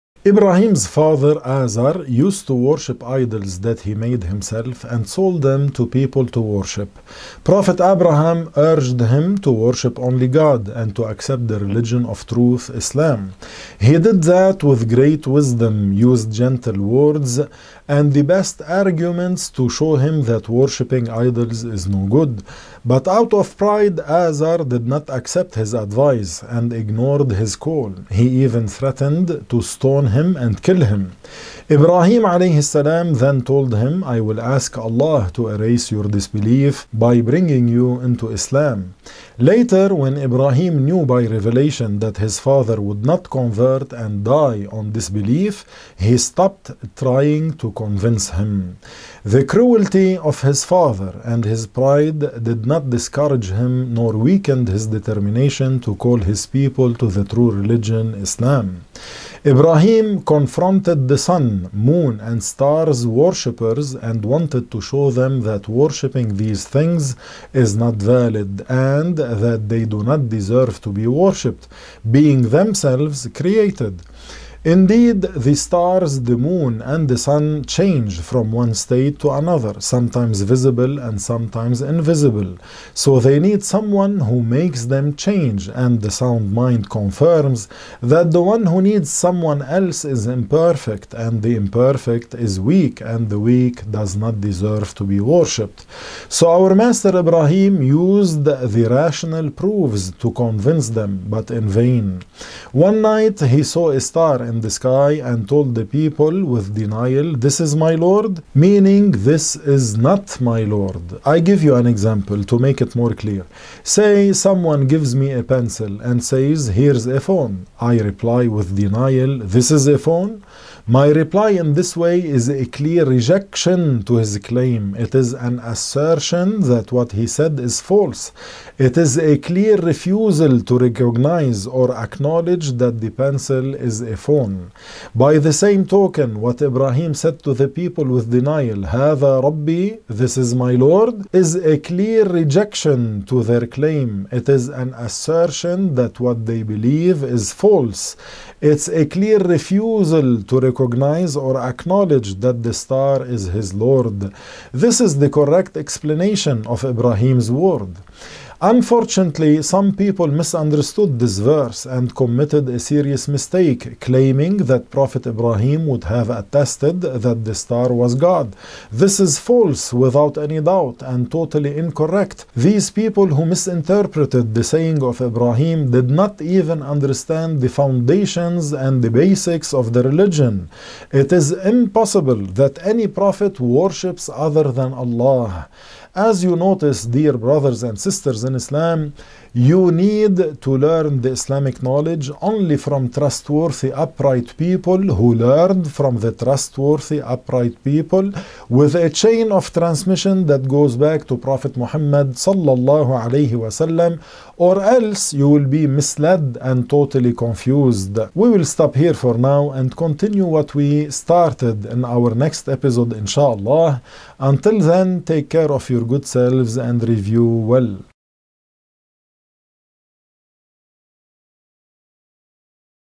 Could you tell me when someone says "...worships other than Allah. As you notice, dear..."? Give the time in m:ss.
3:03.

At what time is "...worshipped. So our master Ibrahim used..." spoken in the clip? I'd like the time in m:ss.
1:35.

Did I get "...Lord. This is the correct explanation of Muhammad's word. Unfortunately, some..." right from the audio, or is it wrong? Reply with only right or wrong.
wrong.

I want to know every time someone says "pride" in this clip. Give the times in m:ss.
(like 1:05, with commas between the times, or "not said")
0:23, 0:51.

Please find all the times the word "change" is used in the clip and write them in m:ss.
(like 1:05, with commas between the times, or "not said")
1:17, 1:25.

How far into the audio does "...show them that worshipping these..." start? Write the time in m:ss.
1:04.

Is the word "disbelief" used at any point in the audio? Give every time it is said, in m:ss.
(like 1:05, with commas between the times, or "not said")
0:36, 0:44.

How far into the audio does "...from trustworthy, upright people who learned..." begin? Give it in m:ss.
3:12.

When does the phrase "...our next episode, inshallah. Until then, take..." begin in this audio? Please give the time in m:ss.
3:32.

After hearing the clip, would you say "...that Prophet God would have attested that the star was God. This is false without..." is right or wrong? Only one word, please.
wrong.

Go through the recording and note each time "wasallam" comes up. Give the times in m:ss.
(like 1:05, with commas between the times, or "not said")
3:23.